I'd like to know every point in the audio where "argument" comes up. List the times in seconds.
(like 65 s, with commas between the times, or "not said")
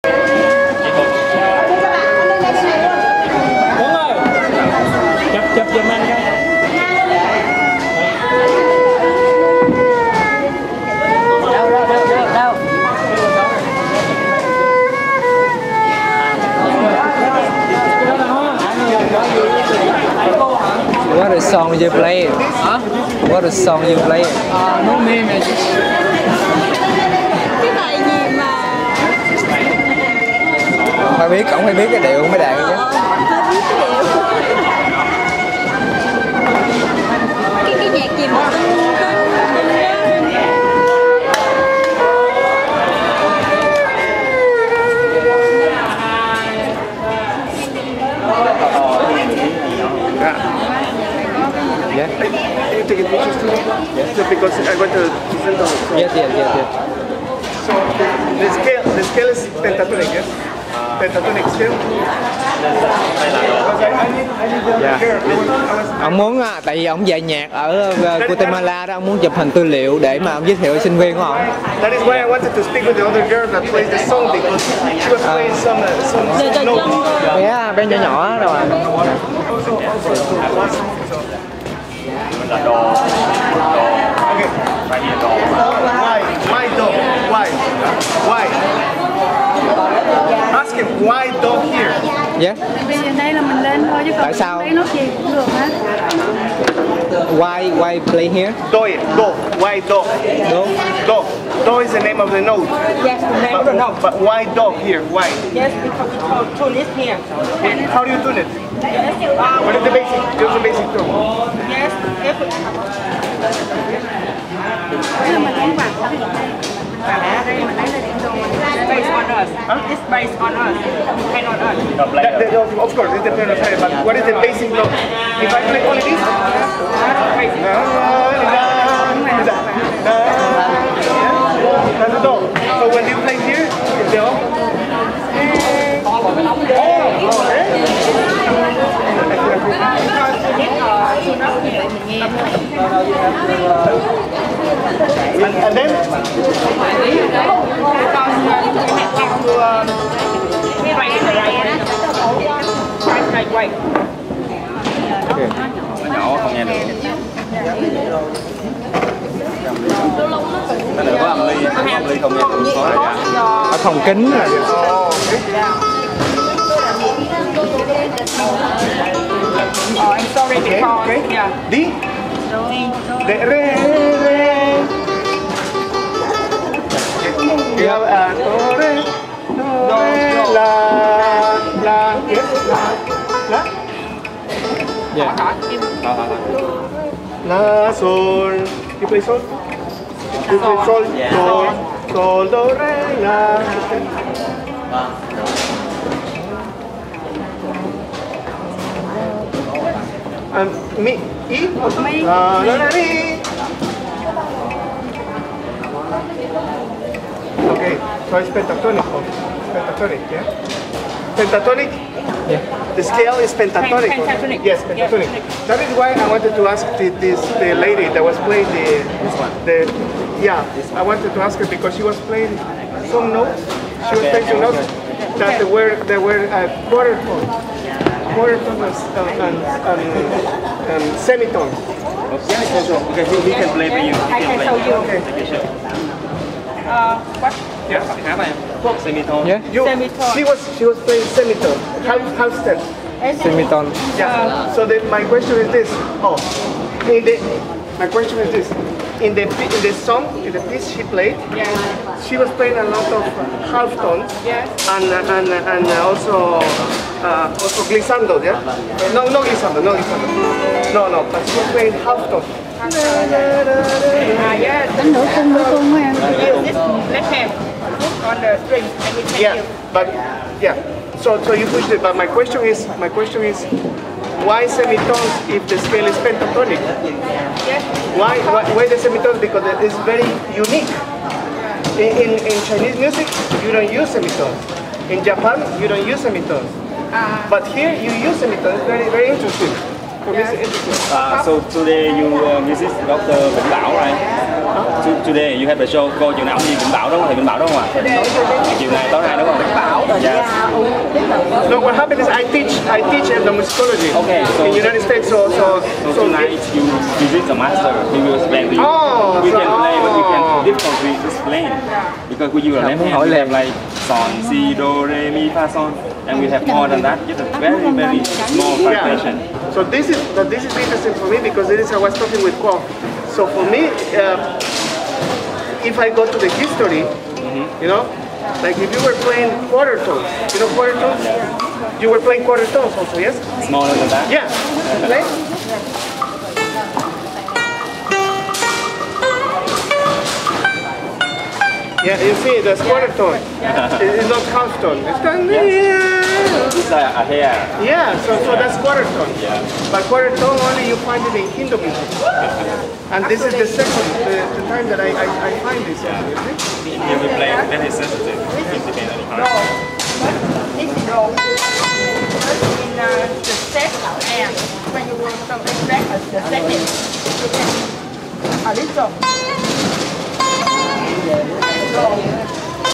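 not said.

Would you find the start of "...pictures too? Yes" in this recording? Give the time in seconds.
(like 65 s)
53 s.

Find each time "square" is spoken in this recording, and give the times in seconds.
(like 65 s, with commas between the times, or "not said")
342 s.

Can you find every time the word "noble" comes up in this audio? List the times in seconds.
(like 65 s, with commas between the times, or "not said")
not said.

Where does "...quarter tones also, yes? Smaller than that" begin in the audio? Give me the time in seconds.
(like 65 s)
332 s.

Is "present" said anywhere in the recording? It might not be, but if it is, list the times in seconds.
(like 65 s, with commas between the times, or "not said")
55 s.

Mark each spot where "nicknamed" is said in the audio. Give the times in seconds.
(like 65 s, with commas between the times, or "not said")
not said.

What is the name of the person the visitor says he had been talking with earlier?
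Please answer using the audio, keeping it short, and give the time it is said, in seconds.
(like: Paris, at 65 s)
Kwok, at 322 s.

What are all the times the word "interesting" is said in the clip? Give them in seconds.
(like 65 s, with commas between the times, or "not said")
289 s, 320 s.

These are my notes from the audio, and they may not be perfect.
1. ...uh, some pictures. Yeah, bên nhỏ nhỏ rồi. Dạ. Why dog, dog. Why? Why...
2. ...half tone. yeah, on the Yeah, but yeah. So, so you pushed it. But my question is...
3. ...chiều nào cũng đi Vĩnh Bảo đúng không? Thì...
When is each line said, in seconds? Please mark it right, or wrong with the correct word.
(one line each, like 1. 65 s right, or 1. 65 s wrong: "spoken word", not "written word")
1. 75 s wrong: "notes", not "pictures"
2. 262 s right
3. 296 s right.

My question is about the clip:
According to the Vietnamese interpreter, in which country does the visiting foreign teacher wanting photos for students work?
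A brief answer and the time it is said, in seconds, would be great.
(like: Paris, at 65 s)
Guatemala, at 68 s.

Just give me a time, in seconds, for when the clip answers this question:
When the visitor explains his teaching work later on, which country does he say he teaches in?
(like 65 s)
304 s.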